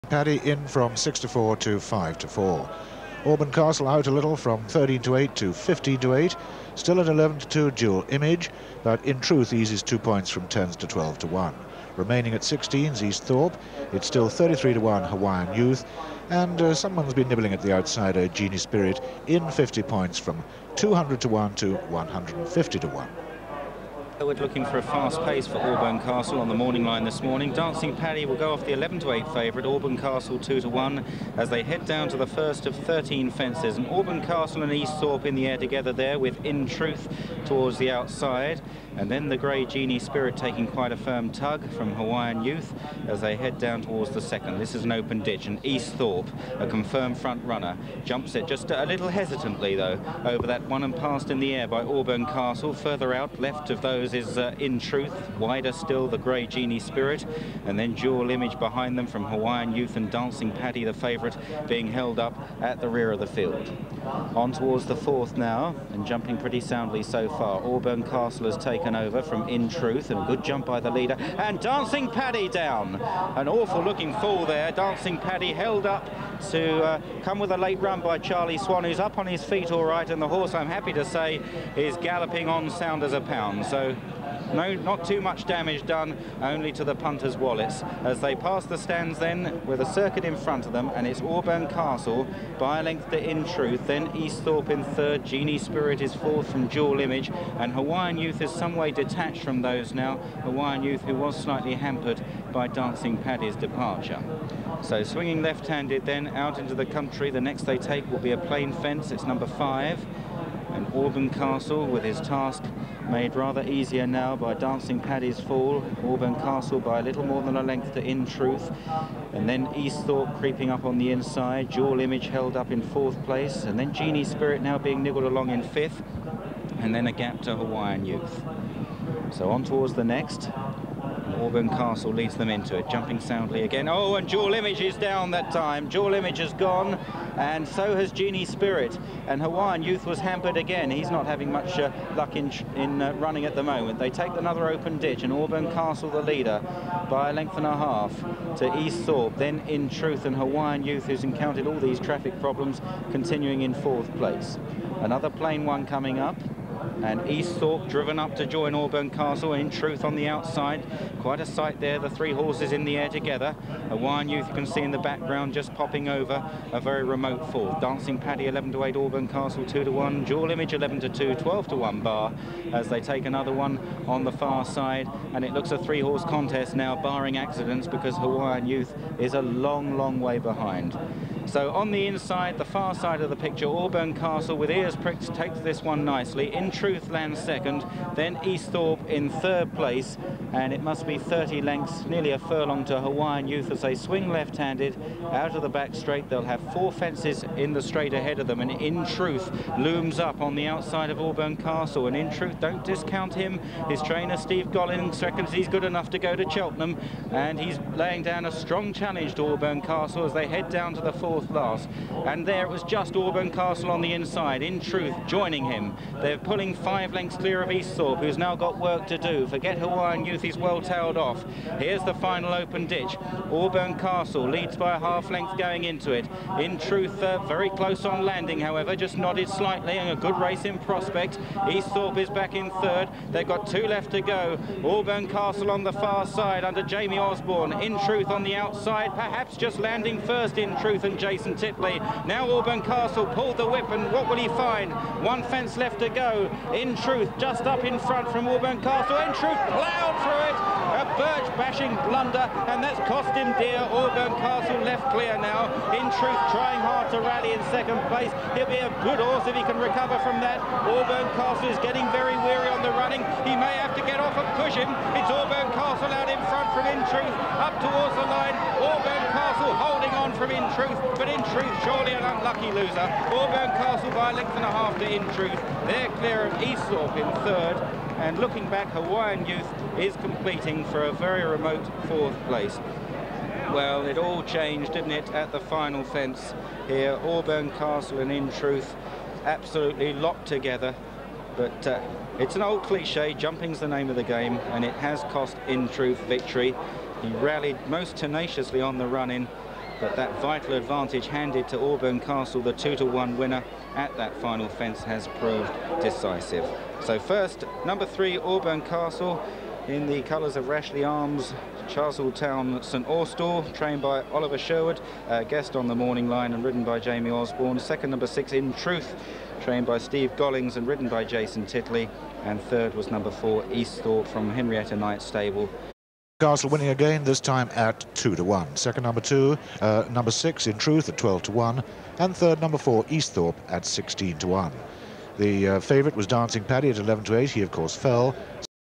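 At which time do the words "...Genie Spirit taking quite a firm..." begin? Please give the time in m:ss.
0:39.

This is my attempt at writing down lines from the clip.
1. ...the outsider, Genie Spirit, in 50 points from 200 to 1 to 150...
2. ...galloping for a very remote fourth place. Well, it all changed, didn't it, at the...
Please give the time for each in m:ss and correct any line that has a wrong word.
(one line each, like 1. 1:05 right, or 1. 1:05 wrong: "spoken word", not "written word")
1. 0:17 right
2. 4:40 wrong: "competing", not "galloping".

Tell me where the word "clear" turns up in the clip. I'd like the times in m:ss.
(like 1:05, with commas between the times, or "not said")
3:37, 4:15, 4:36.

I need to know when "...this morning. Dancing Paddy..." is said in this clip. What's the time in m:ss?
0:27.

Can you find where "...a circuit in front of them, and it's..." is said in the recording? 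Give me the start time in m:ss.
1:29.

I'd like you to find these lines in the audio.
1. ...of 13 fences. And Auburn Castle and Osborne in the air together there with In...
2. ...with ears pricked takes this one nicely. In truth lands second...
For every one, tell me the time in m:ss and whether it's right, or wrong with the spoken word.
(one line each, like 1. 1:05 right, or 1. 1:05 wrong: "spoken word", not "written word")
1. 0:32 wrong: "Easthorpe", not "Osborne"
2. 3:04 right.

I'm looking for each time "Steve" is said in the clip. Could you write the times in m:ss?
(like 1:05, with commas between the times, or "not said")
3:24, 5:19.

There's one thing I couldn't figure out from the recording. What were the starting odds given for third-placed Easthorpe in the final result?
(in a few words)
16 to 1.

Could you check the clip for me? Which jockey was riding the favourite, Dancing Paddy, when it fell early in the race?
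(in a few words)
Charlie Swan.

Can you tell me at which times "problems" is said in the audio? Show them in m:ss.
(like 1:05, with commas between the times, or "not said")
2:32.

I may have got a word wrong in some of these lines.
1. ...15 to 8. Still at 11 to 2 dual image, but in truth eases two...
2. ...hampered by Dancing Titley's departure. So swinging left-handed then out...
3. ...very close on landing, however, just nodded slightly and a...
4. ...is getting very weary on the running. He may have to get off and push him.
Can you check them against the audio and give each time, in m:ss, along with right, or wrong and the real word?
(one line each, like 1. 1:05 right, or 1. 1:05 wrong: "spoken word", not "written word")
1. 0:05 right
2. 1:41 wrong: "Paddy", not "Titley"
3. 3:47 right
4. 4:21 right.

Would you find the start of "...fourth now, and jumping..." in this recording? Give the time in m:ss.
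1:04.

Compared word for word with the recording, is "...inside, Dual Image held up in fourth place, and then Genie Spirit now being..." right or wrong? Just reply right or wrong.
right.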